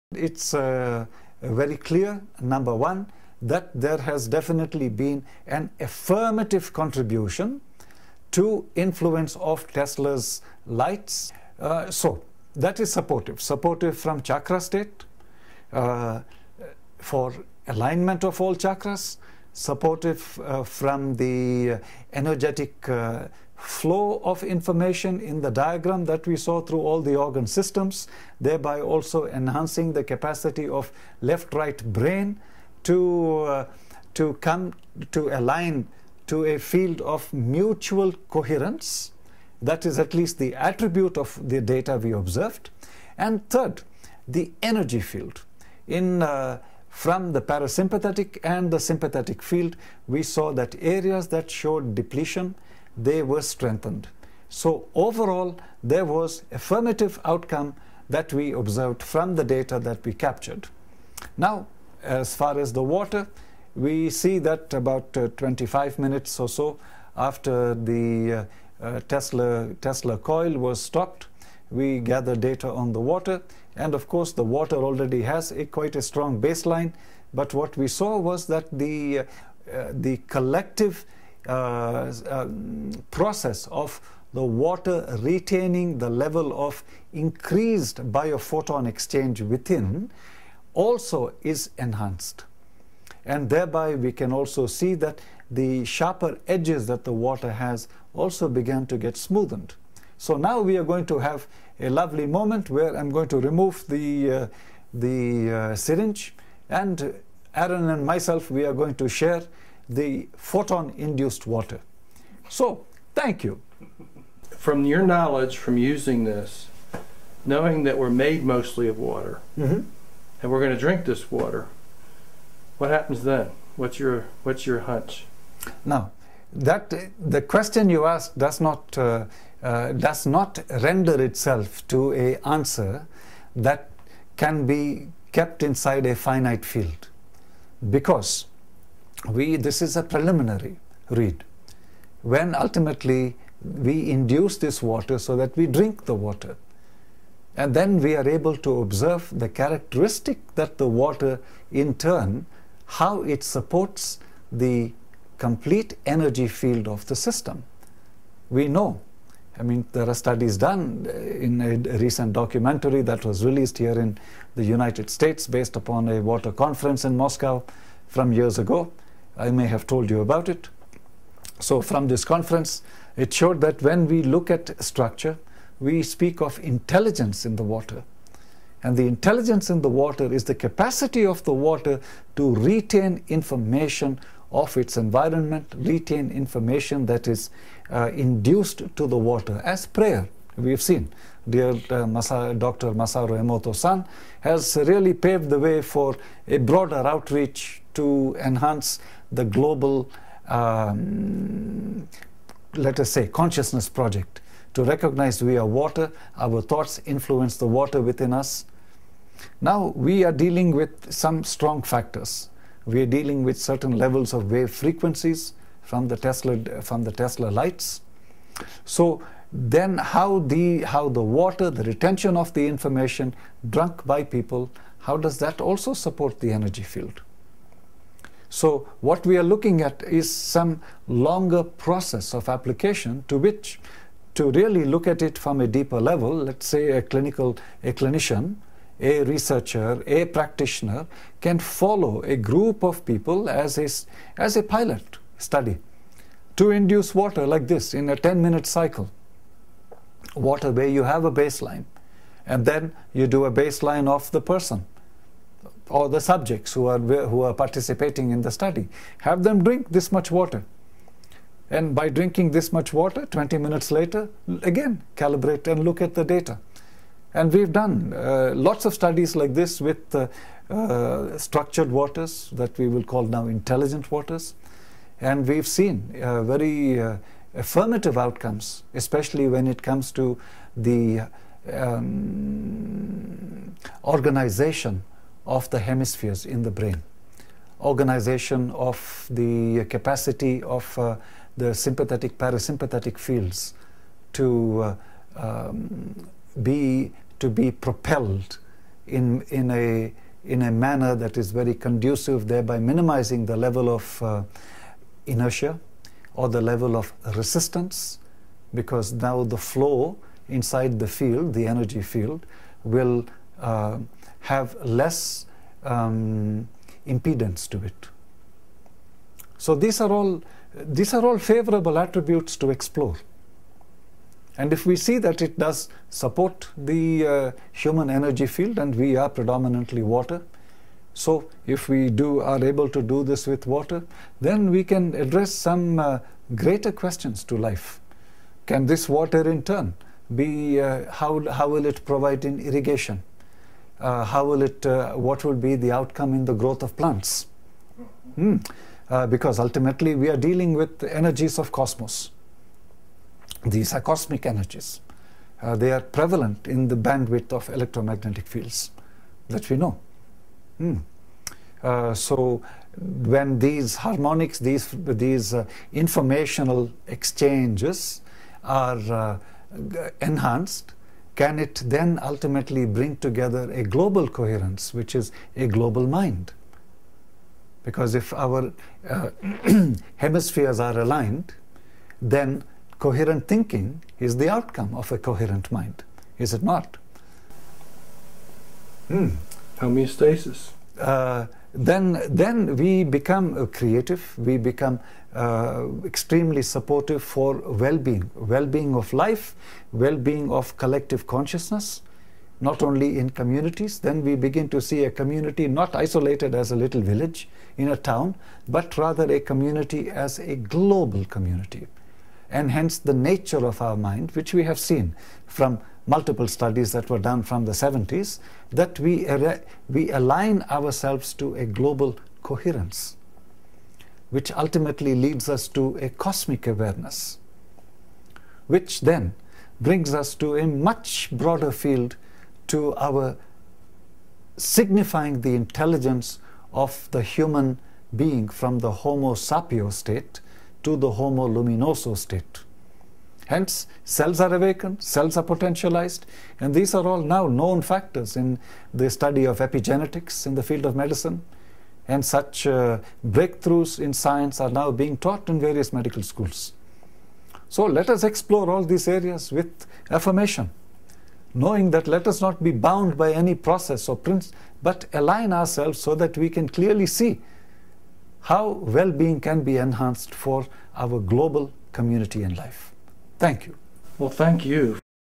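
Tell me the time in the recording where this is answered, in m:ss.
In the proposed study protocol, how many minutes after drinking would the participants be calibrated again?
4:23.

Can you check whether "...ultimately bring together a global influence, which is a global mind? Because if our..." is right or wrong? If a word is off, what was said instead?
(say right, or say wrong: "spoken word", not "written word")
wrong: "coherence", not "influence".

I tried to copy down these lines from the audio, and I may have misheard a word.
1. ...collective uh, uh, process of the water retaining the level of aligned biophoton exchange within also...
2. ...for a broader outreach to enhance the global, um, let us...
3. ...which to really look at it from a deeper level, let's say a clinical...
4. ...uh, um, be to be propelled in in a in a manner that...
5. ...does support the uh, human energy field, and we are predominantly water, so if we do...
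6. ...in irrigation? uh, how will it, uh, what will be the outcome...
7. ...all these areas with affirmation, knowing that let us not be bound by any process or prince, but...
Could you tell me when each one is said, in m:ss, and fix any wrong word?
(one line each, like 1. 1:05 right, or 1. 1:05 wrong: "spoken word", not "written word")
1. 1:20 wrong: "increased", not "aligned"
2. 3:15 right
3. 3:53 right
4. 4:54 right
5. 5:25 right
6. 5:42 right
7. 7:38 right.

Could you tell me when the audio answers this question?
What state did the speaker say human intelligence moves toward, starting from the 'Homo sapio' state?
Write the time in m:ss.
7:21.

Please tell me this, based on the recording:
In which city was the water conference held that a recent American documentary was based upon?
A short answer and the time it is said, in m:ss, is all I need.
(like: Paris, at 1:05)
Moscow, at 2:47.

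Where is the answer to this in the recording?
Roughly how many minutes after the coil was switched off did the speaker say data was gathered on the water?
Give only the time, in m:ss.
1:05.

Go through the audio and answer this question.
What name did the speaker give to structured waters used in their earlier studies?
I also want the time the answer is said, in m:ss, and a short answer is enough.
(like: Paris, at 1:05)
intelligent waters, at 4:33.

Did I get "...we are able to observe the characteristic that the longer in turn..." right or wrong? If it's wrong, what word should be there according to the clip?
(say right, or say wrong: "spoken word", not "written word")
wrong: "water", not "longer".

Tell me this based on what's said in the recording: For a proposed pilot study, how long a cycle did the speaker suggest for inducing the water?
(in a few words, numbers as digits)
10 minutes.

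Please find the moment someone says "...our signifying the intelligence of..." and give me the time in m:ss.
7:12.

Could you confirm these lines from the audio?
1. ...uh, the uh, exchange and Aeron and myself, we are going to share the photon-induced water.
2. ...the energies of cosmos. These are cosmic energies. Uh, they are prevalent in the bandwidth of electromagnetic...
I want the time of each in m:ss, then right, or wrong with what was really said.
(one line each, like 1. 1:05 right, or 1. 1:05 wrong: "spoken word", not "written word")
1. 1:44 wrong: "syringe", not "exchange"
2. 5:50 right.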